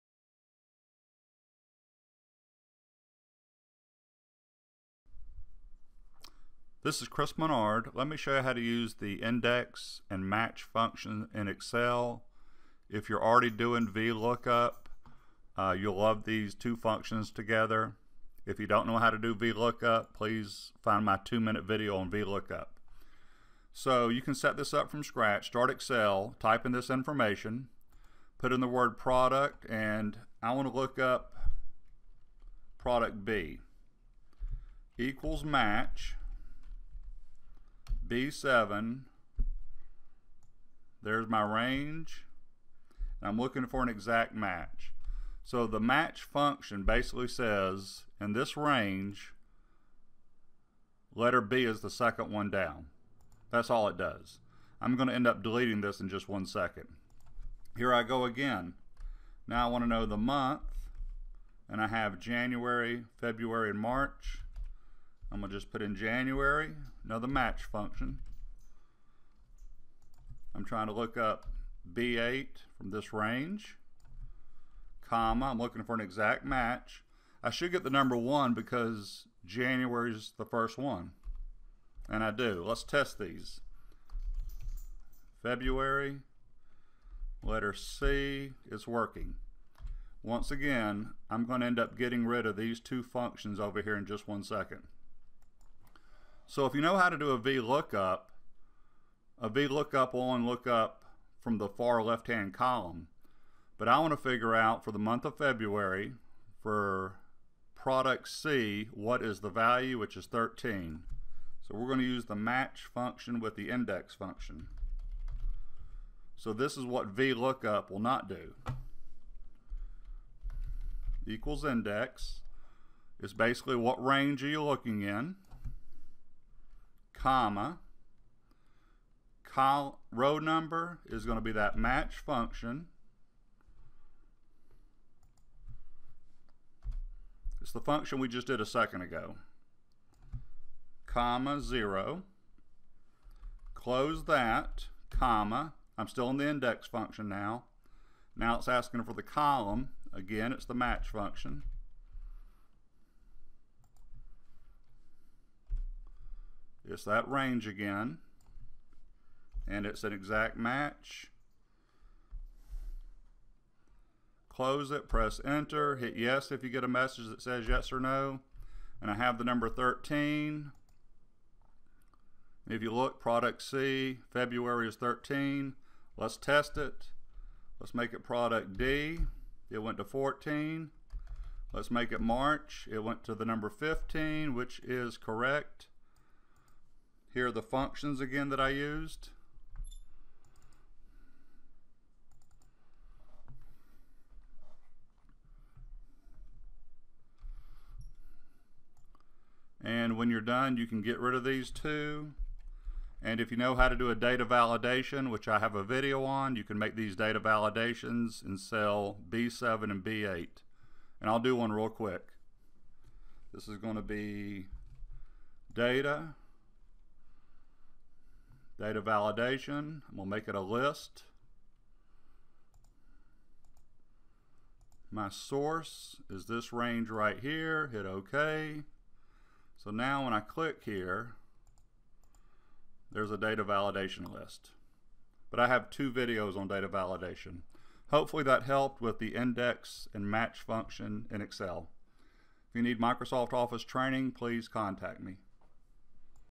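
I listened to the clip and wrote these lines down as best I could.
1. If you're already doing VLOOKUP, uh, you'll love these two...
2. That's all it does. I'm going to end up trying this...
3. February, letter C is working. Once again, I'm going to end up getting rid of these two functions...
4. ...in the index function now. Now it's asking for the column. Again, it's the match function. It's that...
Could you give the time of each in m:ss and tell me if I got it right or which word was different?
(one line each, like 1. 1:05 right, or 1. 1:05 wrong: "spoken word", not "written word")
1. 0:12 right
2. 0:53 wrong: "deleting", not "trying"
3. 1:25 right
4. 2:26 right.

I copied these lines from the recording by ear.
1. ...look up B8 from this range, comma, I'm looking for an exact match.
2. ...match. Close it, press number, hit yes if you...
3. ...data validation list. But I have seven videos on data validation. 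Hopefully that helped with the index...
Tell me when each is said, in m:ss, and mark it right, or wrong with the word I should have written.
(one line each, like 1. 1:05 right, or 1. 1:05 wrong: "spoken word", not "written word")
1. 1:10 right
2. 2:40 wrong: "enter", not "number"
3. 3:53 wrong: "two", not "seven".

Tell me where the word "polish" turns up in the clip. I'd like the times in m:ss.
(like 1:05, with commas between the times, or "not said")
not said.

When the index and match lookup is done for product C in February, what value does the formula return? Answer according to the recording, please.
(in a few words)
13.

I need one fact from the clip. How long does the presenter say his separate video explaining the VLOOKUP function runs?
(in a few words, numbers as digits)
2 minutes.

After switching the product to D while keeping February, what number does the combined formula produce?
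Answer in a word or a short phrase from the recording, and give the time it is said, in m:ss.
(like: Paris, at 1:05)
14, at 2:59.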